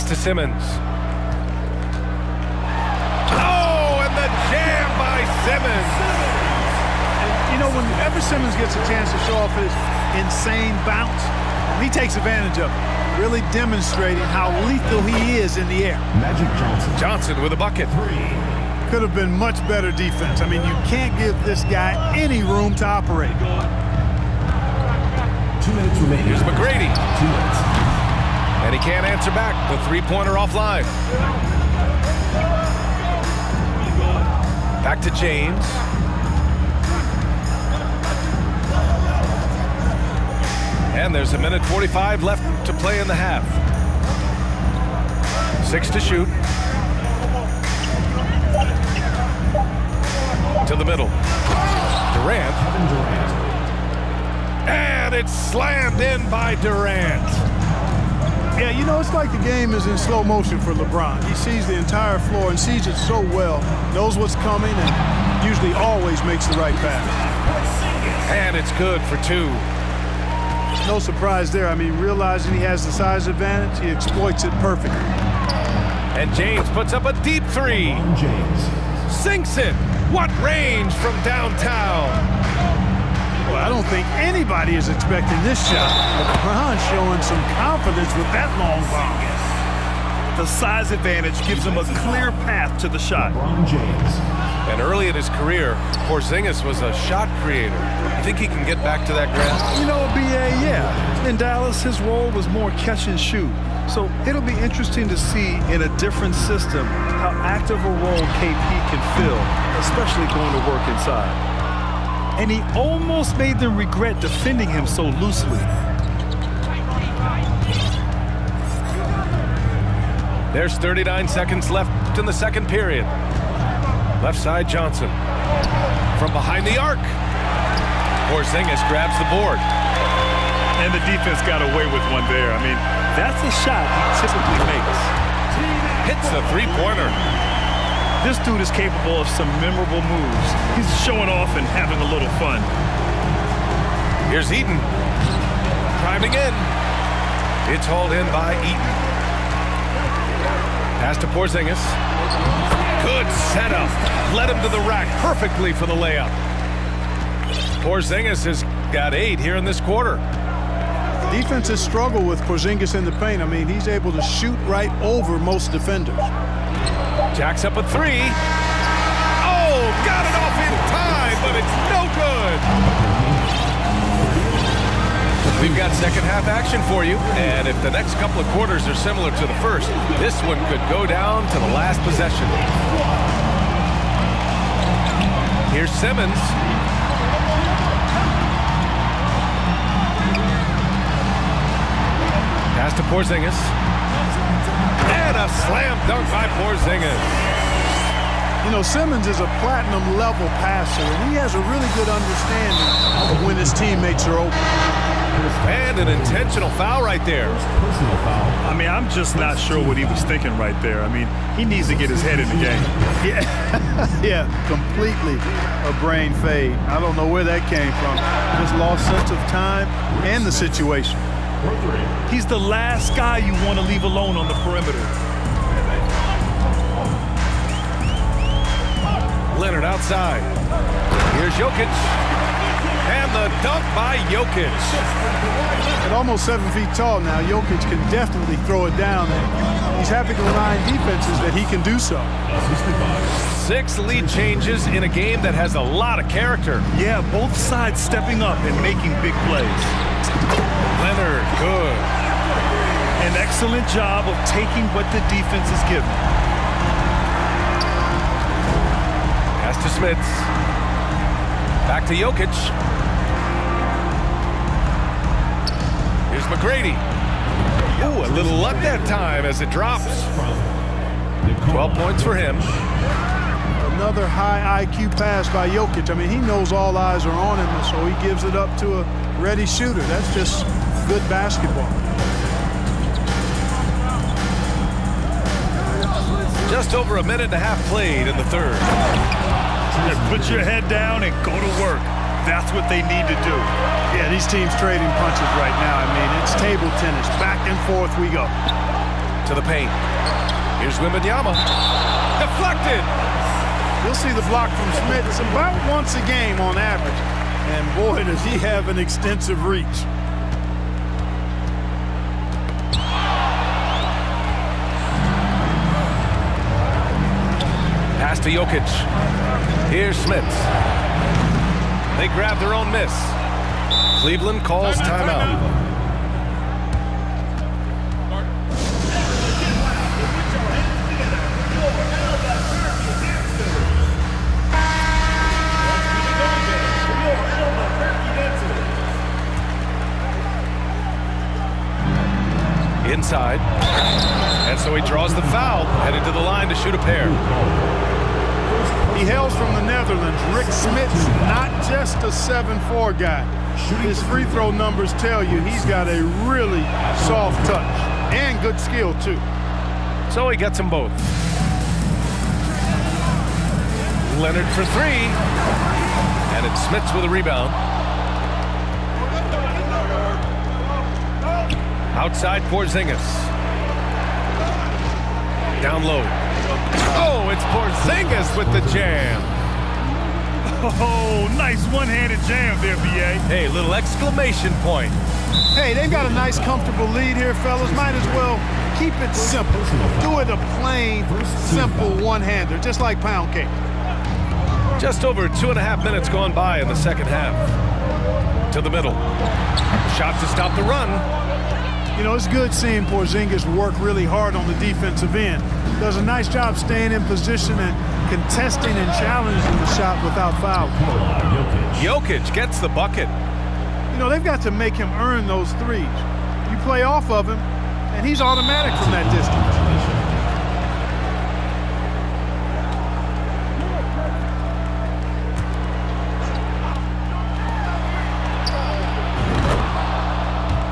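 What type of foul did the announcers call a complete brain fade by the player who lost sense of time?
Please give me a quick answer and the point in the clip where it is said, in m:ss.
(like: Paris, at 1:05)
intentional foul, at 3:26.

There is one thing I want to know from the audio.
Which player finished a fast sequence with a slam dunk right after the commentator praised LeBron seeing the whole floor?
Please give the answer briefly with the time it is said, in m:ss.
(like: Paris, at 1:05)
Kevin Durant, at 0:52.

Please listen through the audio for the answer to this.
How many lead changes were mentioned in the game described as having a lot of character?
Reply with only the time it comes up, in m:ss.
4:03.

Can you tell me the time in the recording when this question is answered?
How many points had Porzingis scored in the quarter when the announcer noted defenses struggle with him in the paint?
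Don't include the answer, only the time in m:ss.
2:39.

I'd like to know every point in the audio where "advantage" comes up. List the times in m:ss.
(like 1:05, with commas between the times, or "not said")
0:12, 1:13, 1:30.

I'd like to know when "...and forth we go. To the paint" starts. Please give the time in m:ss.
4:57.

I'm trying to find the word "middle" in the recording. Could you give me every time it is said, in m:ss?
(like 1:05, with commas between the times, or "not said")
0:50, 6:38.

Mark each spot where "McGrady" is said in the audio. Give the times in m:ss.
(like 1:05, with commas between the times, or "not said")
0:26, 4:26.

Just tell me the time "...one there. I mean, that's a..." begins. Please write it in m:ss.
2:12.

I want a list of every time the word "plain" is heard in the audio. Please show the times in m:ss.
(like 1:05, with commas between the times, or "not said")
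6:30.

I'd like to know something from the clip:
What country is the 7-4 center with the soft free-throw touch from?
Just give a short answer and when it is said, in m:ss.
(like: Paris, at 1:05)
Netherlands, at 5:49.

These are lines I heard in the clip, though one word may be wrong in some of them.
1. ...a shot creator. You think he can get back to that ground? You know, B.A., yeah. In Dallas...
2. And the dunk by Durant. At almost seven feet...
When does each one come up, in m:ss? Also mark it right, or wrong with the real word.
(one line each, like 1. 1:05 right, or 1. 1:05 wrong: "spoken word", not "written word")
1. 1:36 right
2. 3:53 wrong: "Jokic", not "Durant".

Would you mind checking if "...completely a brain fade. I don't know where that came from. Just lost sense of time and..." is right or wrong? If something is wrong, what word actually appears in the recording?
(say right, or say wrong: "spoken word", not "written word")
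right.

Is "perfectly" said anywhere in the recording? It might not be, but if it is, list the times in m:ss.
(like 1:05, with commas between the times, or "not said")
1:14, 2:35.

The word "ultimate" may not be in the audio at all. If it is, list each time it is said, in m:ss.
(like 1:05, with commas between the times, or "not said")
not said.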